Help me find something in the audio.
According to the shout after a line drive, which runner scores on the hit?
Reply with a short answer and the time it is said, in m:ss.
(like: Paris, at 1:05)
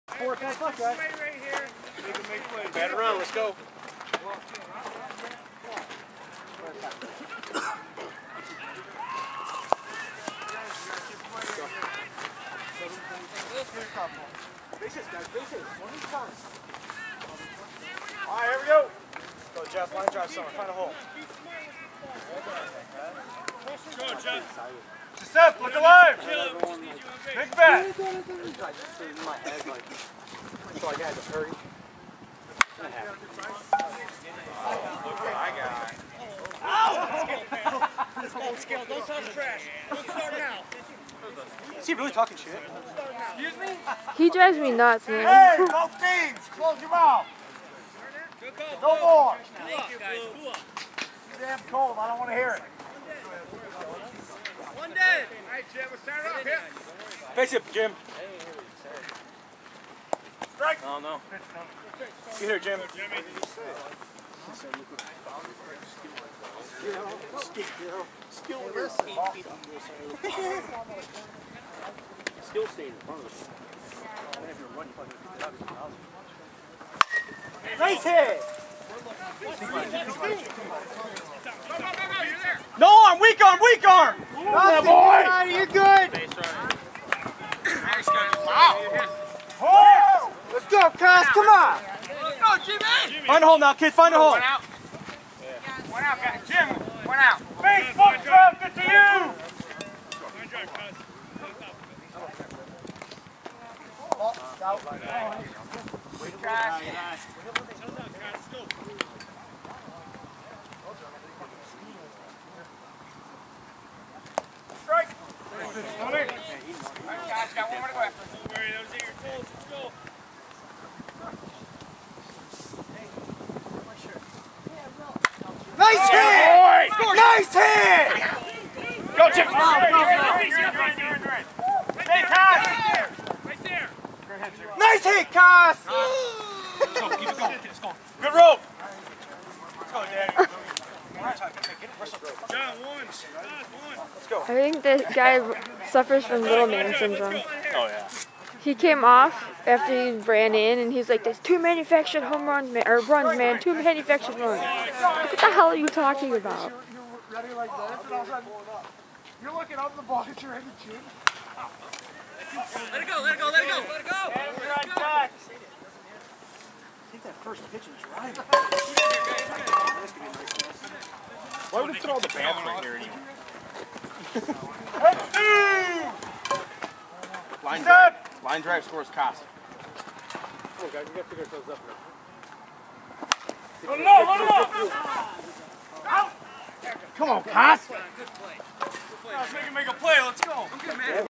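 Costa, at 2:59.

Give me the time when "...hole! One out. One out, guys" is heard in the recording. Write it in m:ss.
1:34.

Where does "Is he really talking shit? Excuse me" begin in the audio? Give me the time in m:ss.
0:41.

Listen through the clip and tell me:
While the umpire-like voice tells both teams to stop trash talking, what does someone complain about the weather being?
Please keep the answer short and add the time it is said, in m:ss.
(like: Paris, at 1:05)
Damn cold, at 0:51.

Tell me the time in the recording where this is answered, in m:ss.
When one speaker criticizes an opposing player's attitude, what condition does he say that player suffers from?
2:26.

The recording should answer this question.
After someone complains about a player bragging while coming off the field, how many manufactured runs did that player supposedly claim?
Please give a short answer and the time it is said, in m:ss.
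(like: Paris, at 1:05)
2, at 2:33.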